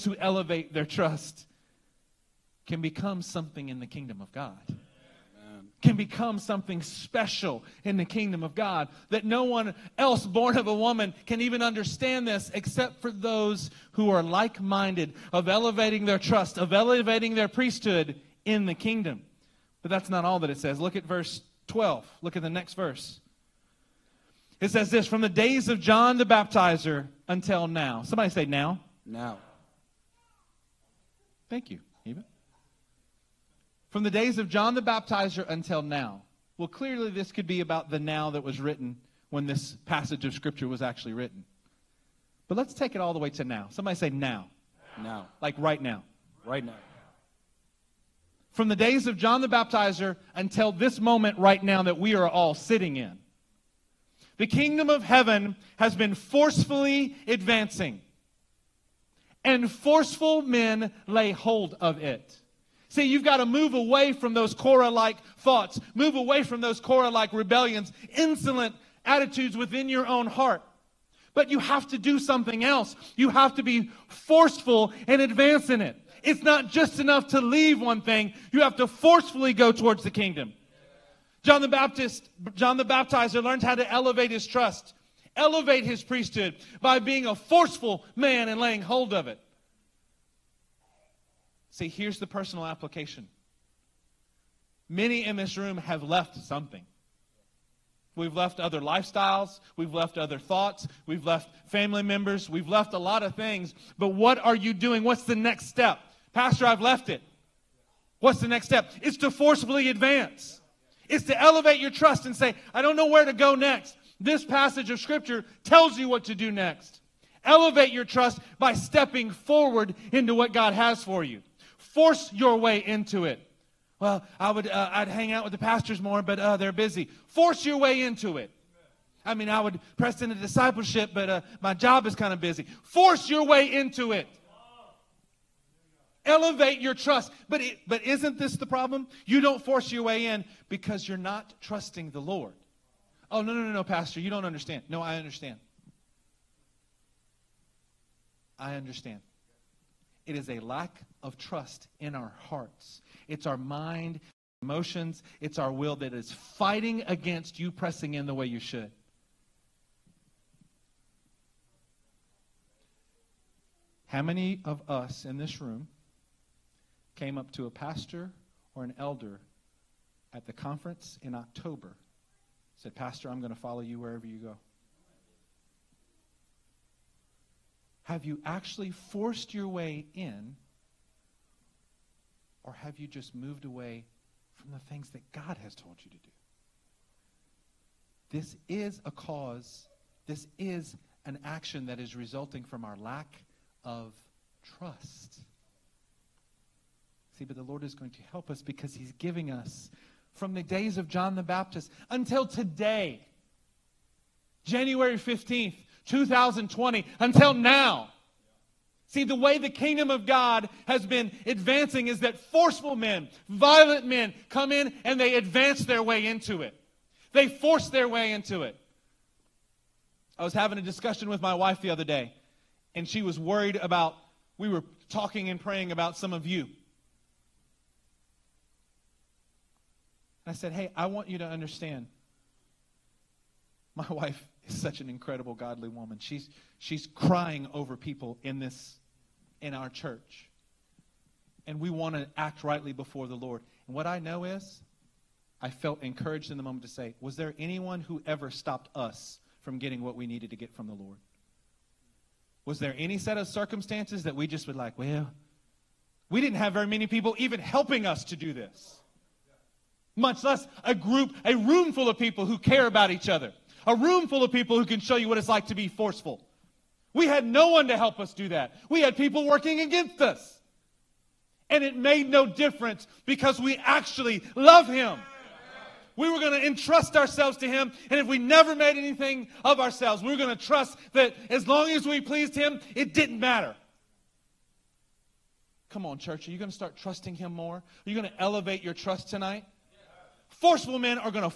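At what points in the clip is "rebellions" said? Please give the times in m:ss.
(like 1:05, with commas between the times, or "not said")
1:07.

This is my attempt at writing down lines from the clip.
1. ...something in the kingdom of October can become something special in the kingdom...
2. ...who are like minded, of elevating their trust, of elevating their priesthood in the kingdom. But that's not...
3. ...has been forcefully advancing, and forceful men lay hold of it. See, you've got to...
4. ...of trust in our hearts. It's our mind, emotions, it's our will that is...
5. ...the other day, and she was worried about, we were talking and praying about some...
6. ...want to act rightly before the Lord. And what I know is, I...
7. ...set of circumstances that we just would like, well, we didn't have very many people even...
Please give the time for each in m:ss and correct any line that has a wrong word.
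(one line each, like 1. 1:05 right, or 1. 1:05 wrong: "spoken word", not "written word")
1. 0:03 wrong: "God", not "October"
2. 0:13 right
3. 0:55 right
4. 2:31 right
5. 3:41 right
6. 4:01 right
7. 4:13 right.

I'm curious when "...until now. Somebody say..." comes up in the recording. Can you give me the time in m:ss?
0:27.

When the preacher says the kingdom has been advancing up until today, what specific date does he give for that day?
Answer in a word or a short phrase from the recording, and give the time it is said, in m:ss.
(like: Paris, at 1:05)
January 15th, 2020, at 3:24.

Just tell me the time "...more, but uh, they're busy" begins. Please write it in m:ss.
2:06.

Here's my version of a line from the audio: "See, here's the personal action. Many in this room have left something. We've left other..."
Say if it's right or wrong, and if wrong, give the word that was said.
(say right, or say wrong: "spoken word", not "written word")
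wrong: "application", not "action".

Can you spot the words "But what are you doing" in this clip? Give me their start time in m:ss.
1:43.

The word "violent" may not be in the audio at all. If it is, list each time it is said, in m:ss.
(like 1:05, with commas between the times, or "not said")
3:33.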